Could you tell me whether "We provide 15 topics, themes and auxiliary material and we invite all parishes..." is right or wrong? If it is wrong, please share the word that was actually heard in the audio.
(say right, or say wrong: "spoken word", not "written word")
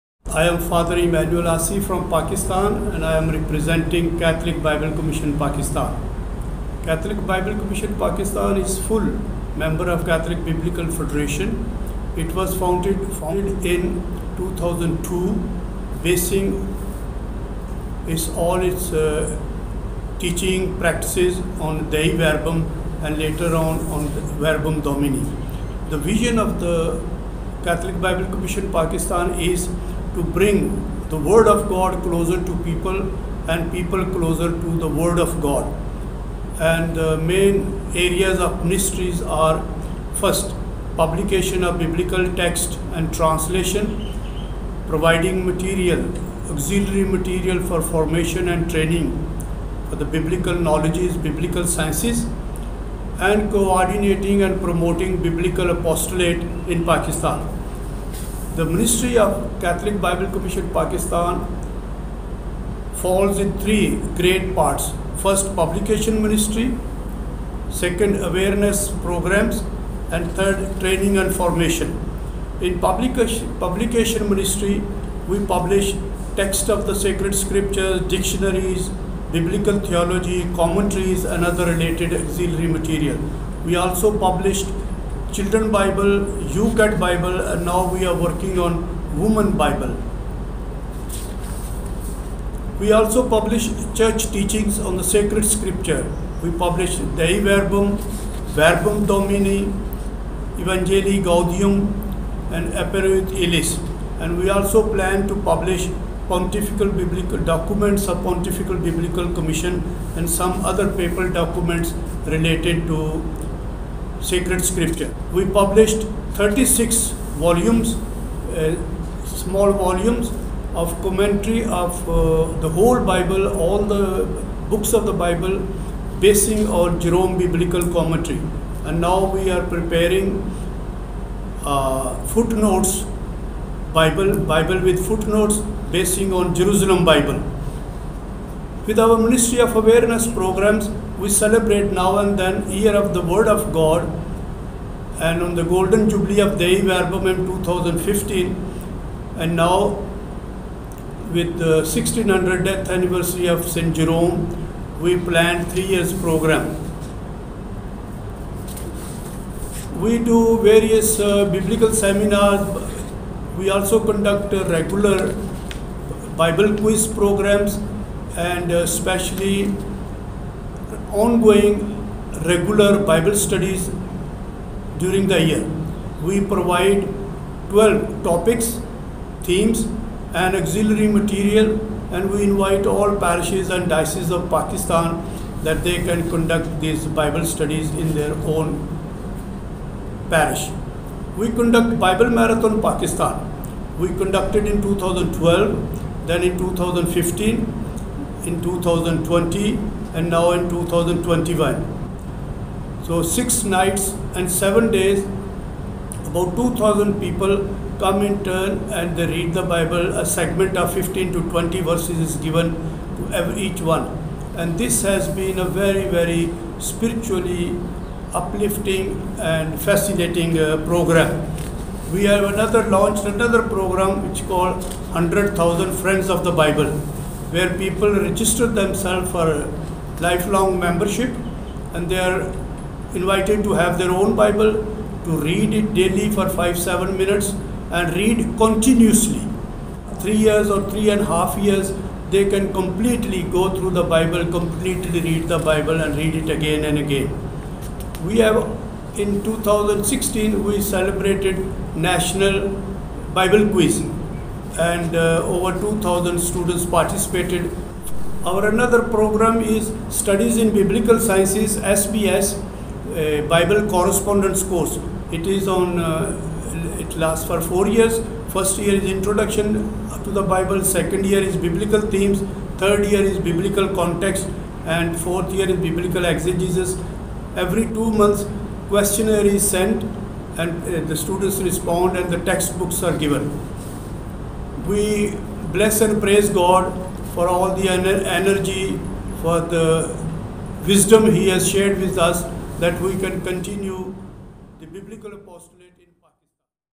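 wrong: "12", not "15".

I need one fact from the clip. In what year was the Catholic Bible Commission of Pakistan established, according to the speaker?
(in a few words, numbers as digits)
2002.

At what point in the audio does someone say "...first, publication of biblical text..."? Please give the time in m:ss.
0:40.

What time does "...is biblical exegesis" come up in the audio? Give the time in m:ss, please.
4:35.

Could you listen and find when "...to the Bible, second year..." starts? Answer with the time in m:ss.
4:30.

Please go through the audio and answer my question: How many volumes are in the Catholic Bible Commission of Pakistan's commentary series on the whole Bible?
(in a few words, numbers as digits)
36.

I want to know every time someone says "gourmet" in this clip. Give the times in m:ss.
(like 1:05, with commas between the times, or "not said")
not said.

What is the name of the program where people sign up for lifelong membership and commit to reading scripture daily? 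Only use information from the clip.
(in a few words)
100,000 Friends of the Bible.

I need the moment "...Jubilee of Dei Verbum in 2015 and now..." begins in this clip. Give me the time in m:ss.
2:26.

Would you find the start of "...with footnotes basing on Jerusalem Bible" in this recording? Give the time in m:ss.
2:14.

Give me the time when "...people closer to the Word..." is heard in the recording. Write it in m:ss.
0:33.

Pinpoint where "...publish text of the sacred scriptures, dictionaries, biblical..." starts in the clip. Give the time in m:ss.
1:15.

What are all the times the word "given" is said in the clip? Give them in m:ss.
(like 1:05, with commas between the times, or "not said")
3:32, 4:43.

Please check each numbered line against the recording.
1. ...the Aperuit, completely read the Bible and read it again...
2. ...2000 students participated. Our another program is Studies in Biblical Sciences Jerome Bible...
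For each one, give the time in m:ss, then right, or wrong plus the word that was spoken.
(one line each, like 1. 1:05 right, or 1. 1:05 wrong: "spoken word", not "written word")
1. 4:03 wrong: "Bible", not "Aperuit"
2. 4:15 wrong: "SBS", not "Jerome".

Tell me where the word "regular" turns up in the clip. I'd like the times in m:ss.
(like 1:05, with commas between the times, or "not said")
2:44, 2:52.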